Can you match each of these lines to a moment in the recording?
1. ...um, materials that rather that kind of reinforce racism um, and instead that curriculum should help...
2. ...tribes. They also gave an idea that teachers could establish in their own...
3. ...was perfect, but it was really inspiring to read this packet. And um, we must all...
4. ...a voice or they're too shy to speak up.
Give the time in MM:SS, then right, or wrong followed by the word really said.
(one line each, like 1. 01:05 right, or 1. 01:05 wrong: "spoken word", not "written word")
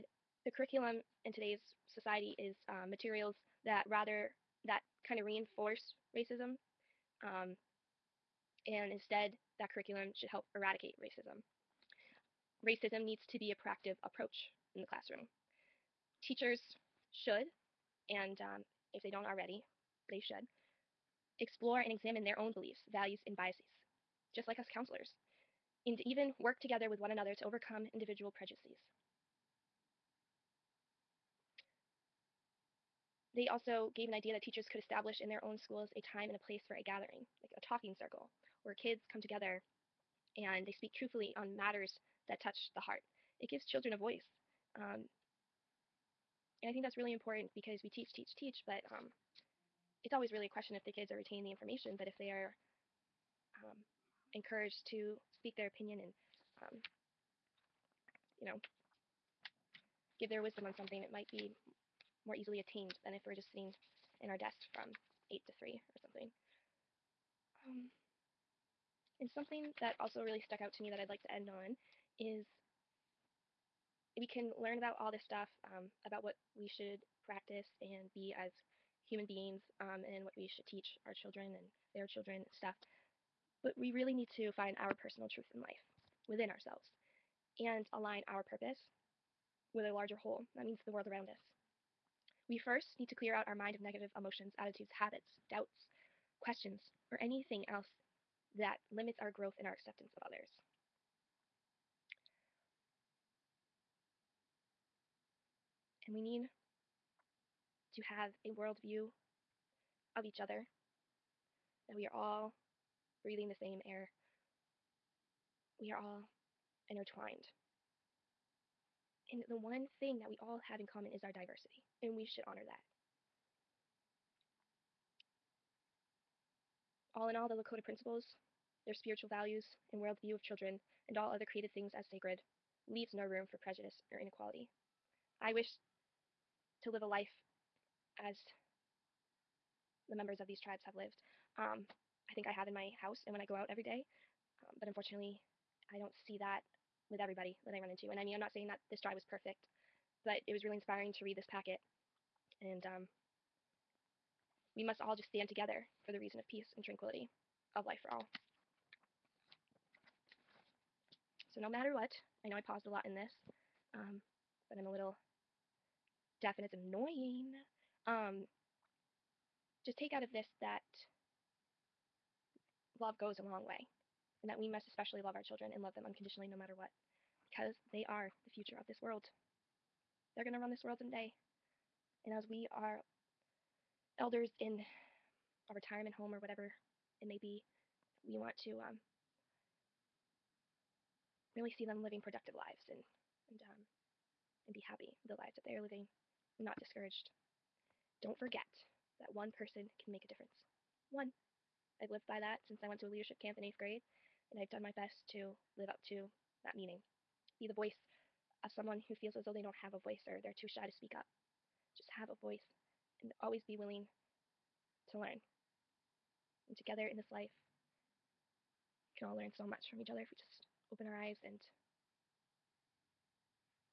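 1. 00:02 right
2. 00:28 wrong: "prejudices", not "tribes"
3. 02:29 right
4. 03:29 right.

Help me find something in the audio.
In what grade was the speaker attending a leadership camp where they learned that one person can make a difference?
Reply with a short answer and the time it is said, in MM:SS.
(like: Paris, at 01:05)
eighth grade, at 03:23.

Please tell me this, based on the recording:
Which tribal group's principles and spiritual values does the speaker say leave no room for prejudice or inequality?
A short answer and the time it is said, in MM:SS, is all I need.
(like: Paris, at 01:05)
Lakota, at 02:07.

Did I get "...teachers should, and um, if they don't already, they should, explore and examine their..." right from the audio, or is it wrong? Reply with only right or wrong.
right.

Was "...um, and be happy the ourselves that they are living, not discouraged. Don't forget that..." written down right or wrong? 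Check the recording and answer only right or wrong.
wrong.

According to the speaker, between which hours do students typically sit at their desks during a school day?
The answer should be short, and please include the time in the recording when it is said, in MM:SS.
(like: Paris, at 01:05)
8 to 3, at 01:05.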